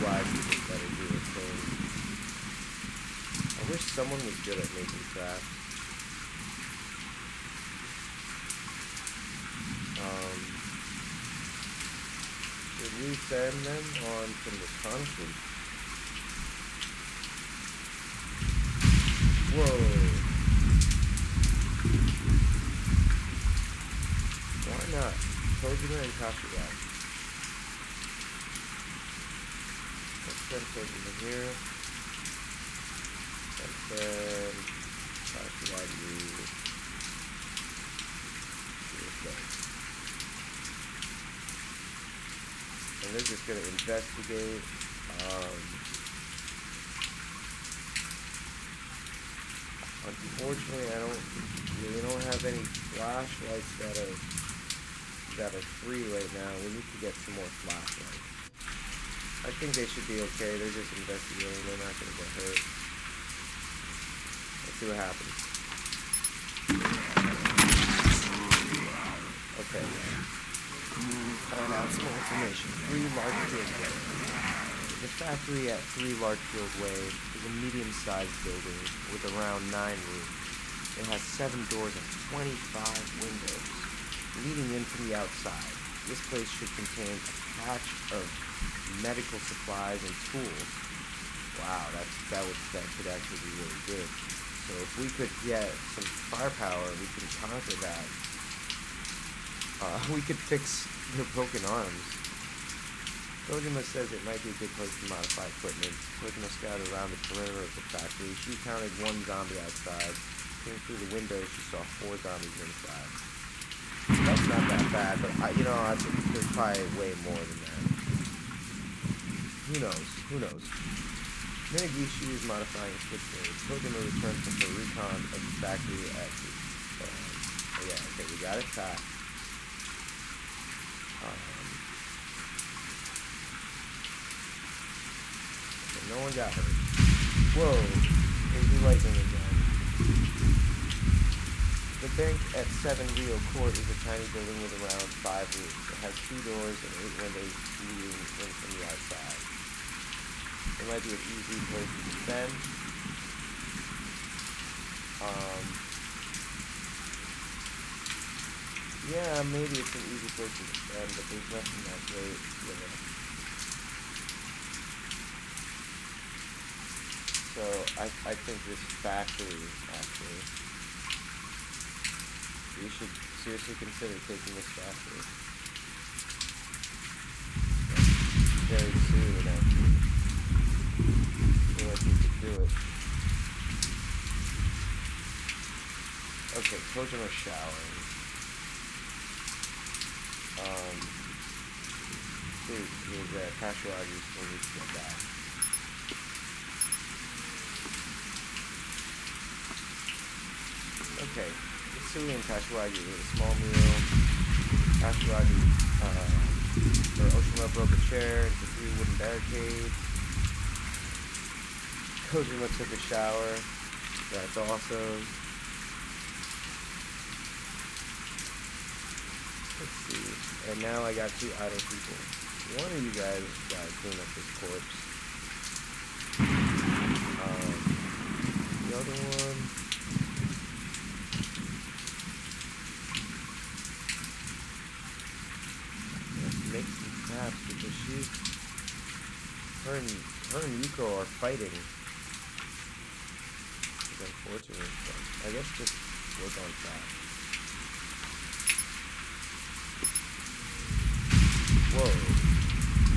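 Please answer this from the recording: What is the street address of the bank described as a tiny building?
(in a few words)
7 Rio Court.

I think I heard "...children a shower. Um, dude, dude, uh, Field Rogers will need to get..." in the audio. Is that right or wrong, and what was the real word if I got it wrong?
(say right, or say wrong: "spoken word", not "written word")
wrong: "Cash", not "Field".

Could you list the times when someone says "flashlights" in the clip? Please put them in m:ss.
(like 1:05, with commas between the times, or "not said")
0:52, 0:57.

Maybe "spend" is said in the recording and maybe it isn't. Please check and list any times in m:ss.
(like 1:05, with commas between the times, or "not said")
2:32, 2:40.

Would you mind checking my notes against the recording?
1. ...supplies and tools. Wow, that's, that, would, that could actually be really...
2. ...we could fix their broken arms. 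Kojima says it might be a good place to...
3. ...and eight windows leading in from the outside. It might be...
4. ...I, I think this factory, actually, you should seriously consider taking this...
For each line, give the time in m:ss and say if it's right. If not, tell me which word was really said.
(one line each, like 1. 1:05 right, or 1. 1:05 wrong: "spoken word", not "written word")
1. 1:29 right
2. 1:40 right
3. 2:26 right
4. 2:47 right.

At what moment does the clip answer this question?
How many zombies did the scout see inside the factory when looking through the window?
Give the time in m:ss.
1:52.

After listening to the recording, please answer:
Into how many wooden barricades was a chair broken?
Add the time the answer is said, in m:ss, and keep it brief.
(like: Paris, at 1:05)
3, at 3:28.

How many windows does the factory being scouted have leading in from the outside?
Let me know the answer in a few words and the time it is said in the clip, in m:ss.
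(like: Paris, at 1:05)
25, at 1:22.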